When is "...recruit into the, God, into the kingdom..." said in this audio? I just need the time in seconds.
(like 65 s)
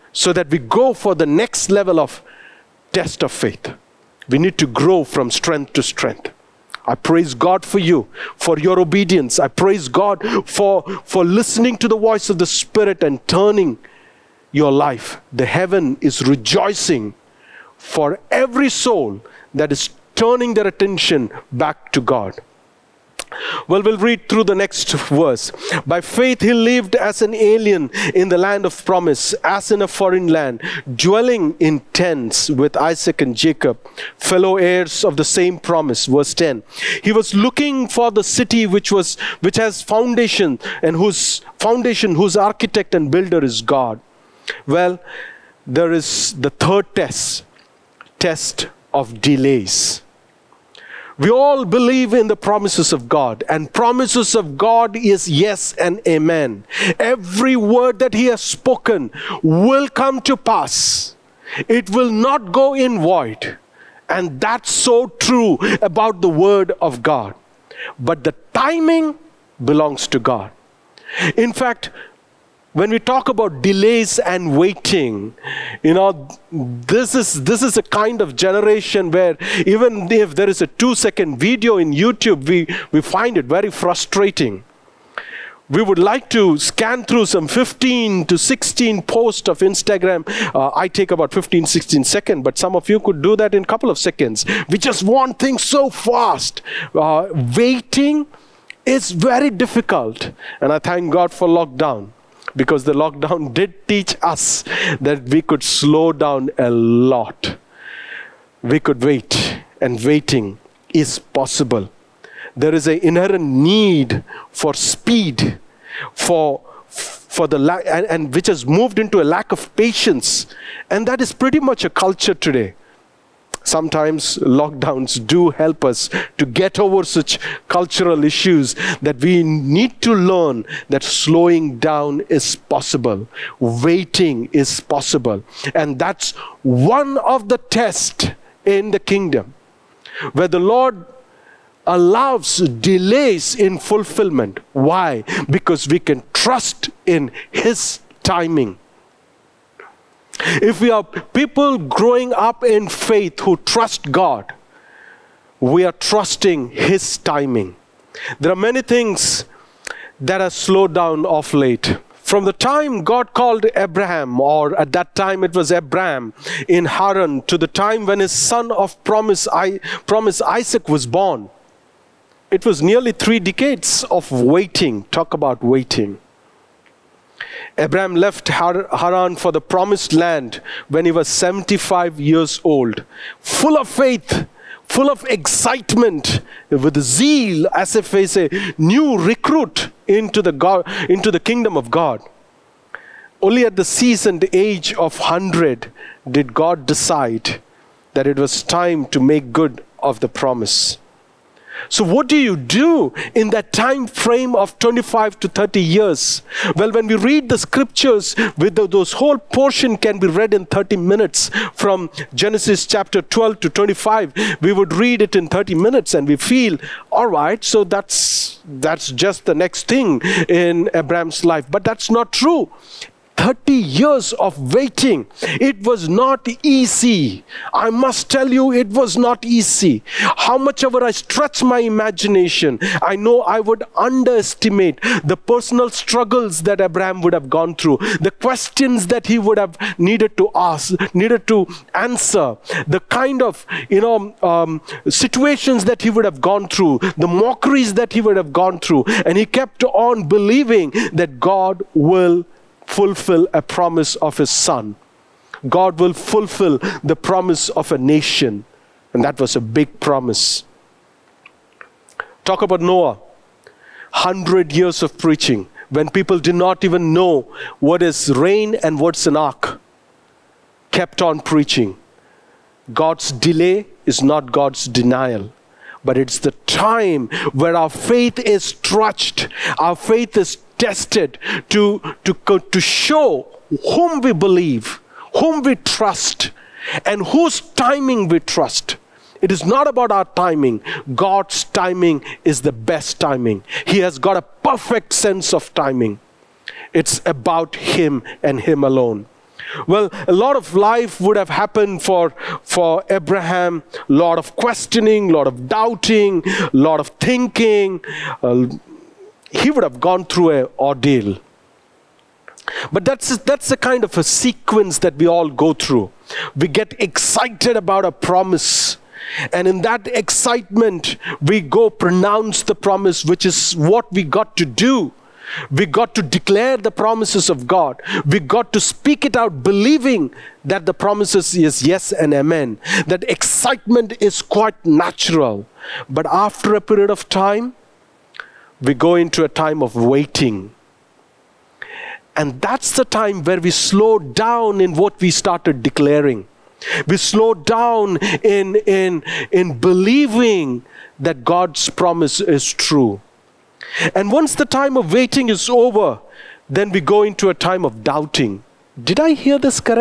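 189 s.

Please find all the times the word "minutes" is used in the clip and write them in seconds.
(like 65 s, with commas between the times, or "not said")
210 s, 215 s.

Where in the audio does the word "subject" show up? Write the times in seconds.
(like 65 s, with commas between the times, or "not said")
not said.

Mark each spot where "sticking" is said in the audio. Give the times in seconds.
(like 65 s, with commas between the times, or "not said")
not said.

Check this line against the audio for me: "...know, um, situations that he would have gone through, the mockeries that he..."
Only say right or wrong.
right.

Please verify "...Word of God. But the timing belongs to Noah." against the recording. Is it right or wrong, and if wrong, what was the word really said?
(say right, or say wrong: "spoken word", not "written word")
wrong: "God", not "Noah".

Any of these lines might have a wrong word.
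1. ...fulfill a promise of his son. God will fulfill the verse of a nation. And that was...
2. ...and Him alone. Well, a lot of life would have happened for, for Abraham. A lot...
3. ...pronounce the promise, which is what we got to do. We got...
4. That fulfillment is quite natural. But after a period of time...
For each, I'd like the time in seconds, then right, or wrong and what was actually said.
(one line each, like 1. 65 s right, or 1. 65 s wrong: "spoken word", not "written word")
1. 252 s wrong: "promise", not "verse"
2. 298 s right
3. 321 s right
4. 333 s wrong: "excitement", not "fulfillment".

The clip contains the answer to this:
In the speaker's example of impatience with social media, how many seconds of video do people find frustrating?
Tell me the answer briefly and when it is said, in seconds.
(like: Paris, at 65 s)
2, at 80 s.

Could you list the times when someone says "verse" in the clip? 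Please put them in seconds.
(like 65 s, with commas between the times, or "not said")
24 s, 36 s.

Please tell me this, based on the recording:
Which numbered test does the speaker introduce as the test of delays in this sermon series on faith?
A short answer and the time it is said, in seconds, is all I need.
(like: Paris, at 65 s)
third, at 46 s.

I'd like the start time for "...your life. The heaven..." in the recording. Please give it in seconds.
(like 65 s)
14 s.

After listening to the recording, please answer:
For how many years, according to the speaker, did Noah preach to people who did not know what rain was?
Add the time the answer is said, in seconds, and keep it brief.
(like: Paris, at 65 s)
100, at 264 s.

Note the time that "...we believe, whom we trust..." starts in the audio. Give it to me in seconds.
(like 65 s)
284 s.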